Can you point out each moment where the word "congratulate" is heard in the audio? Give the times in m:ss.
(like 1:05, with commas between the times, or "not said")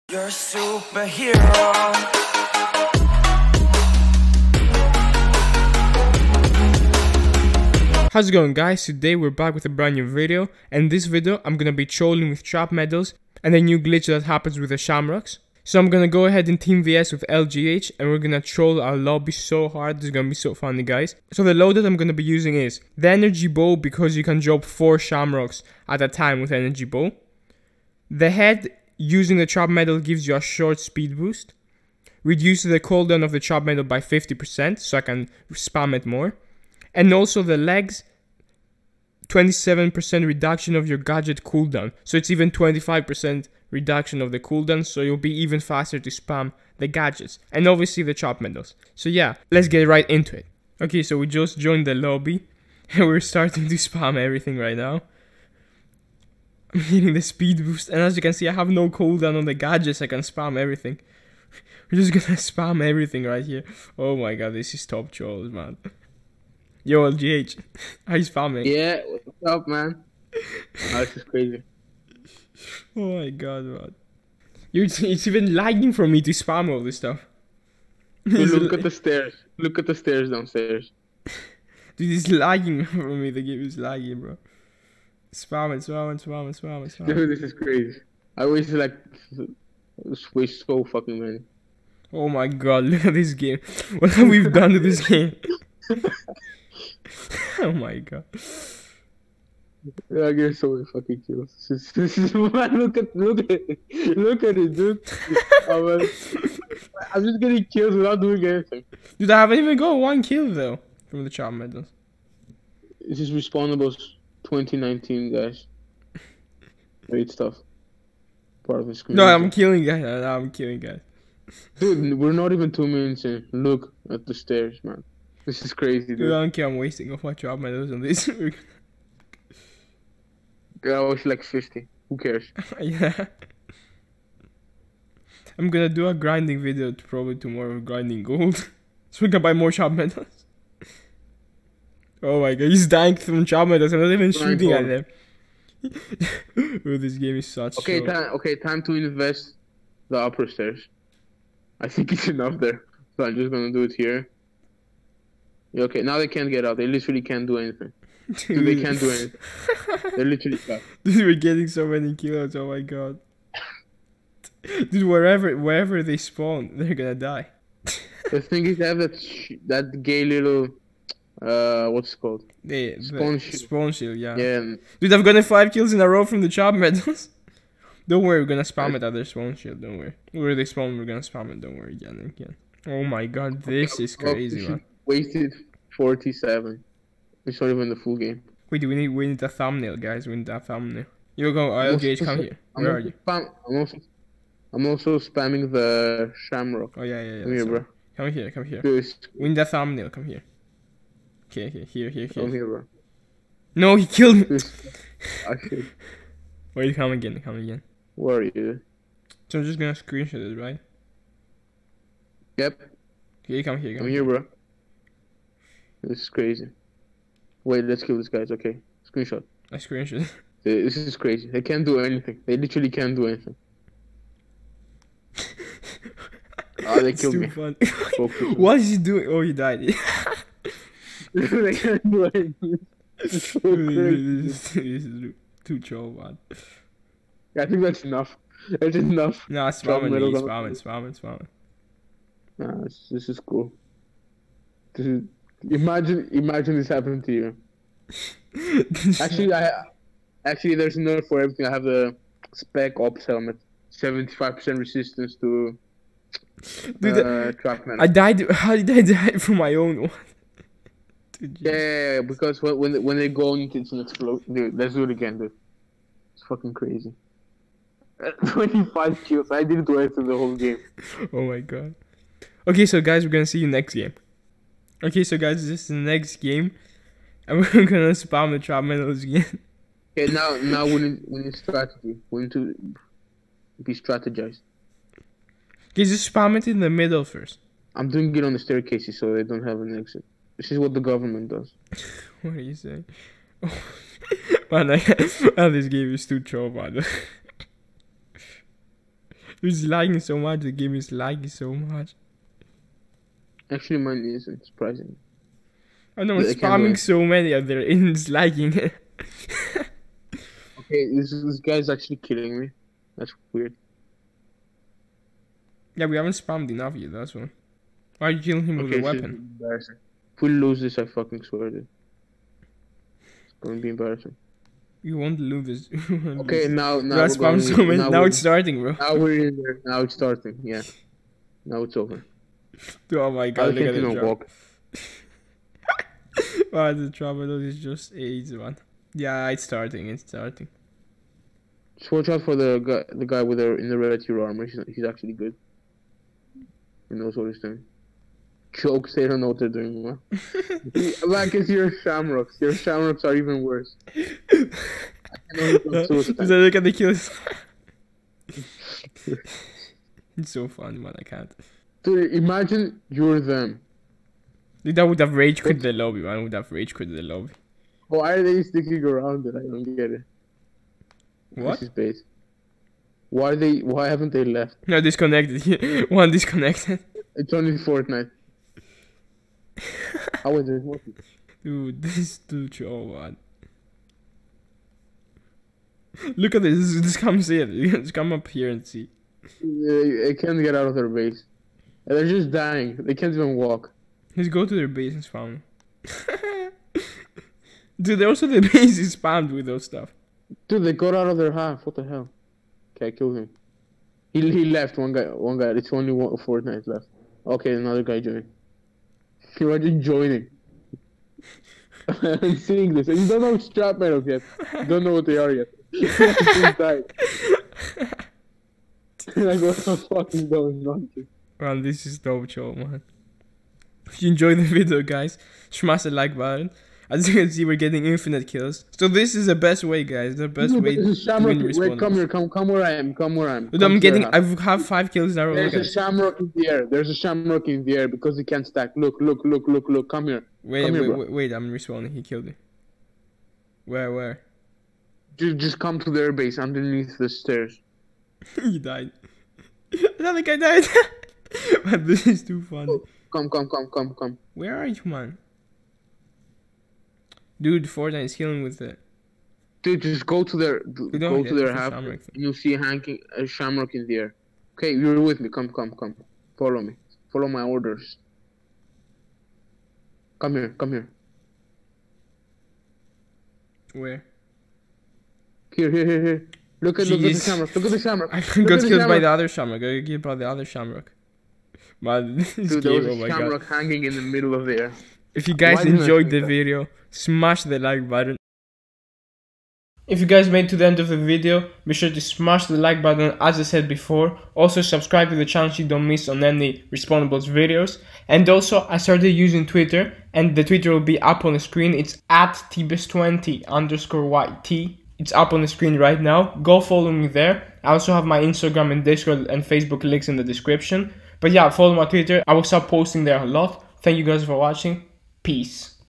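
not said.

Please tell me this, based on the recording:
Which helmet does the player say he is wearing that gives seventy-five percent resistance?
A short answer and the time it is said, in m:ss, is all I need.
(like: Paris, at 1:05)
spec ops helmet, at 4:12.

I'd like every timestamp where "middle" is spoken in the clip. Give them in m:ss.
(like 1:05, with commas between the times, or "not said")
4:46, 8:04.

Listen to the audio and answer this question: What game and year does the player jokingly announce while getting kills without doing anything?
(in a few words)
Respawnables 2019.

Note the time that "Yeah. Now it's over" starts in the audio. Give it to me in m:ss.
5:30.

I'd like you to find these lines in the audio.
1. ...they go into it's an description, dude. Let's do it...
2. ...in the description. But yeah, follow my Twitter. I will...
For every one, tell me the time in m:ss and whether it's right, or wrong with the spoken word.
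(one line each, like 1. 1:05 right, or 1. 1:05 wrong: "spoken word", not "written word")
1. 4:23 wrong: "explosion", not "description"
2. 8:30 right.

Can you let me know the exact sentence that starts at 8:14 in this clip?
Also subscribe to the channel so you don't miss on any Respawnables videos.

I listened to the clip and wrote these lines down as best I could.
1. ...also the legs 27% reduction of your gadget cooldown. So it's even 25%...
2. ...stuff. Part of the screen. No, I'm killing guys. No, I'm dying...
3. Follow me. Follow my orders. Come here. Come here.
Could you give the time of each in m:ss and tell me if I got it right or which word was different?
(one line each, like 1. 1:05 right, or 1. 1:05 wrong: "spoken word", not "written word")
1. 0:37 right
2. 1:57 wrong: "killing", not "dying"
3. 7:46 right.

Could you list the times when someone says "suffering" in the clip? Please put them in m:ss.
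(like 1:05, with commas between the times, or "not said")
not said.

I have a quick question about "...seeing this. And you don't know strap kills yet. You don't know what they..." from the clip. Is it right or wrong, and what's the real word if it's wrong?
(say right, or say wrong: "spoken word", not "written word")
wrong: "metals", not "kills".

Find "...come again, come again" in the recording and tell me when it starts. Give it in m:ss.
3:26.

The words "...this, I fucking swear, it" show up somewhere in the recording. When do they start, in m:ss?
5:20.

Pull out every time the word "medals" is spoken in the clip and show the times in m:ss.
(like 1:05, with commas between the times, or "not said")
0:12, 0:48, 1:51, 2:07, 2:19, 2:56, 4:38.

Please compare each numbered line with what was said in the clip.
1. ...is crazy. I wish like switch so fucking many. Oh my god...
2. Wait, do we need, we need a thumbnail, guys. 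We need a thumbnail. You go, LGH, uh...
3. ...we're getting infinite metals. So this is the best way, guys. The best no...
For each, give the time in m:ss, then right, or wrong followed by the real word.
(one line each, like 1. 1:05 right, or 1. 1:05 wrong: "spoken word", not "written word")
1. 1:27 right
2. 3:08 right
3. 7:07 wrong: "kills", not "metals".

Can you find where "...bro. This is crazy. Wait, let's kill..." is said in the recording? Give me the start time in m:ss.
3:34.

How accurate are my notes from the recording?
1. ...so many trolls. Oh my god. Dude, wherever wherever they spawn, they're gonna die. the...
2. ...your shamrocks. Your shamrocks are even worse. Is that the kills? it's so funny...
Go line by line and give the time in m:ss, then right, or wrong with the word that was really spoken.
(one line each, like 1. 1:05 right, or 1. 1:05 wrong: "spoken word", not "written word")
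1. 2:41 wrong: "kills", not "trolls"
2. 5:51 right.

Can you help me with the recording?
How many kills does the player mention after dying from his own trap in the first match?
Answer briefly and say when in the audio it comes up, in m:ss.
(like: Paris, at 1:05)
25, at 4:28.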